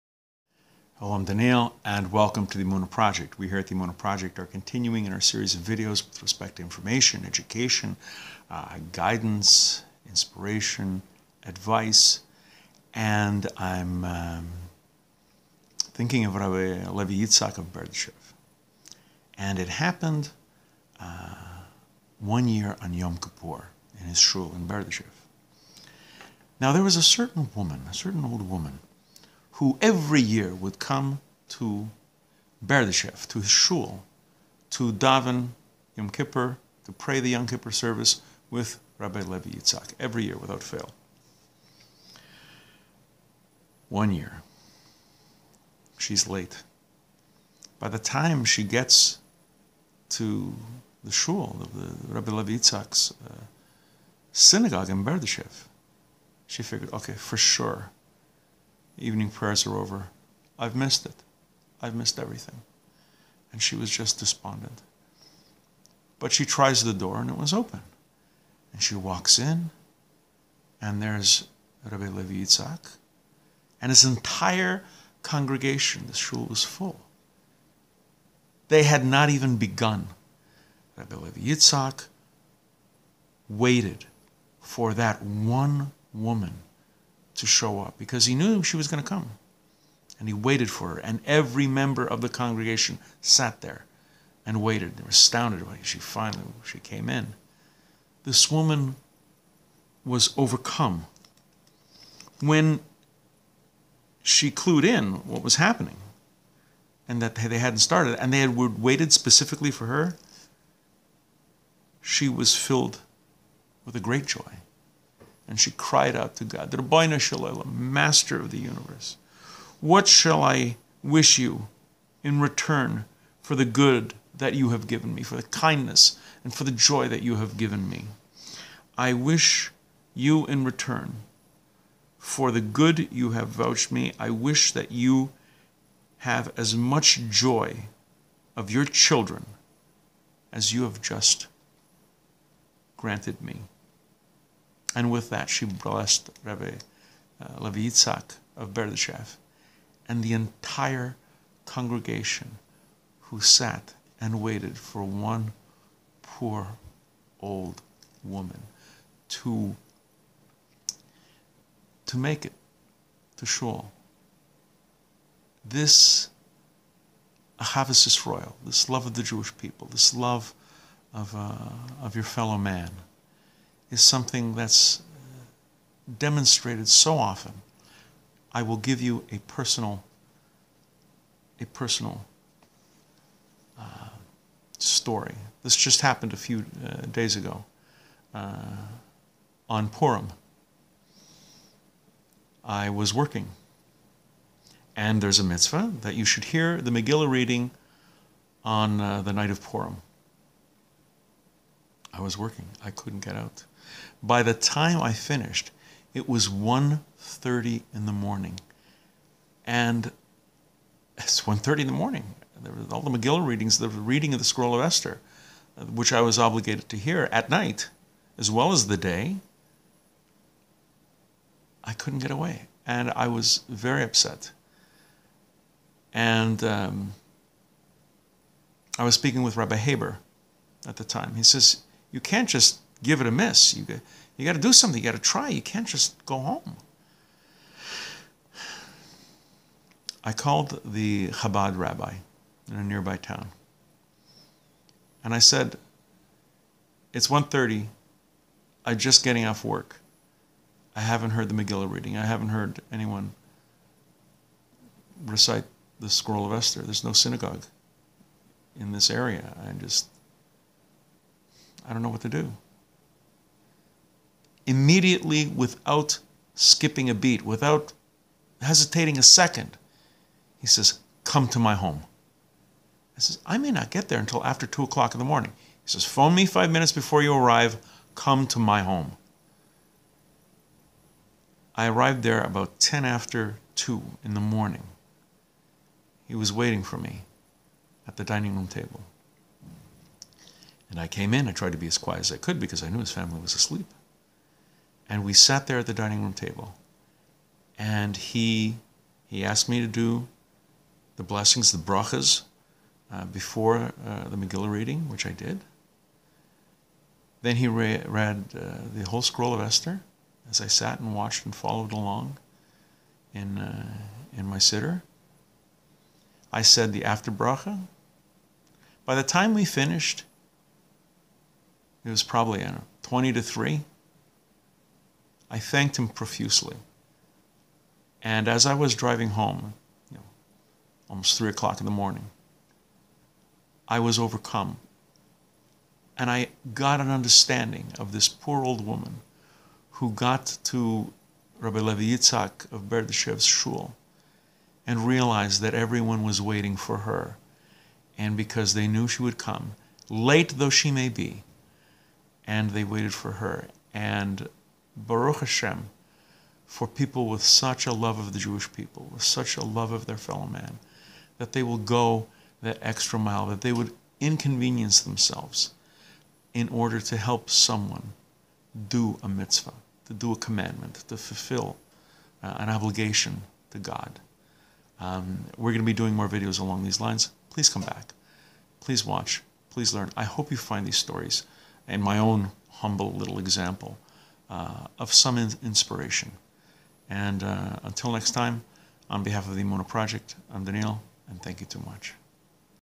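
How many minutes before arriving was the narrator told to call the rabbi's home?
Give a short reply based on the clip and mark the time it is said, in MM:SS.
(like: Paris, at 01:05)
5, at 04:36.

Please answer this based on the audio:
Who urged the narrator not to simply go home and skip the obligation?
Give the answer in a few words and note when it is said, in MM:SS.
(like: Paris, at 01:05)
Rabbi Haber, at 03:49.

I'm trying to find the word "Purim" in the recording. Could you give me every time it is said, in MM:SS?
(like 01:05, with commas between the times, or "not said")
03:09, 03:19.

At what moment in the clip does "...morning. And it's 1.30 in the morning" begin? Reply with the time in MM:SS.
03:28.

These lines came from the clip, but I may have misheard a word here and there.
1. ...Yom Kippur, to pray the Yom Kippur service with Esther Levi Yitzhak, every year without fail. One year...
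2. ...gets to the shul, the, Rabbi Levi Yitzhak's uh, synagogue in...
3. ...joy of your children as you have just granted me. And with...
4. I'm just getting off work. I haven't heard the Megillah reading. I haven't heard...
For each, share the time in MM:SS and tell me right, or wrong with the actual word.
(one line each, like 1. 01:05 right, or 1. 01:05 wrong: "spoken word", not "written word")
1. 00:35 wrong: "Rabbi", not "Esther"
2. 00:48 right
3. 02:17 right
4. 04:08 right.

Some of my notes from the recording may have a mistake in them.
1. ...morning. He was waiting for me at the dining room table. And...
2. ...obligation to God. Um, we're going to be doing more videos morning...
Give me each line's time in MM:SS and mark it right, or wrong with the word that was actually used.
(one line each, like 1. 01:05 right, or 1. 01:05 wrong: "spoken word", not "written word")
1. 04:44 right
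2. 06:12 wrong: "along", not "morning".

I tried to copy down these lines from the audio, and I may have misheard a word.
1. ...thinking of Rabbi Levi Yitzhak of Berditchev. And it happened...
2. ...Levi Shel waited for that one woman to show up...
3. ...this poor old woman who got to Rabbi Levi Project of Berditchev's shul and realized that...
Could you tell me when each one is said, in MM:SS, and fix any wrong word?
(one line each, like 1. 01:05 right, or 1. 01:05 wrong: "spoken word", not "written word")
1. 00:15 right
2. 01:21 wrong: "Yitzhak", not "Shel"
3. 05:38 wrong: "Yitzhak", not "Project".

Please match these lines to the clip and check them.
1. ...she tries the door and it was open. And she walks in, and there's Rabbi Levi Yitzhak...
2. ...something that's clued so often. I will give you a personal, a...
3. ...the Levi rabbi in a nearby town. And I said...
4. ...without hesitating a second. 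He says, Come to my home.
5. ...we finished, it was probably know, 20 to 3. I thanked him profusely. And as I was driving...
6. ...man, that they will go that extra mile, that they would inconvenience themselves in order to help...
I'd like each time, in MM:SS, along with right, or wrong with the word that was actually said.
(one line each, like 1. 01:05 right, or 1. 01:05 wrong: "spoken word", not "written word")
1. 01:06 right
2. 02:54 wrong: "demonstrated", not "clued"
3. 04:00 wrong: "Chabad", not "Levi"
4. 04:27 right
5. 05:19 right
6. 06:00 right.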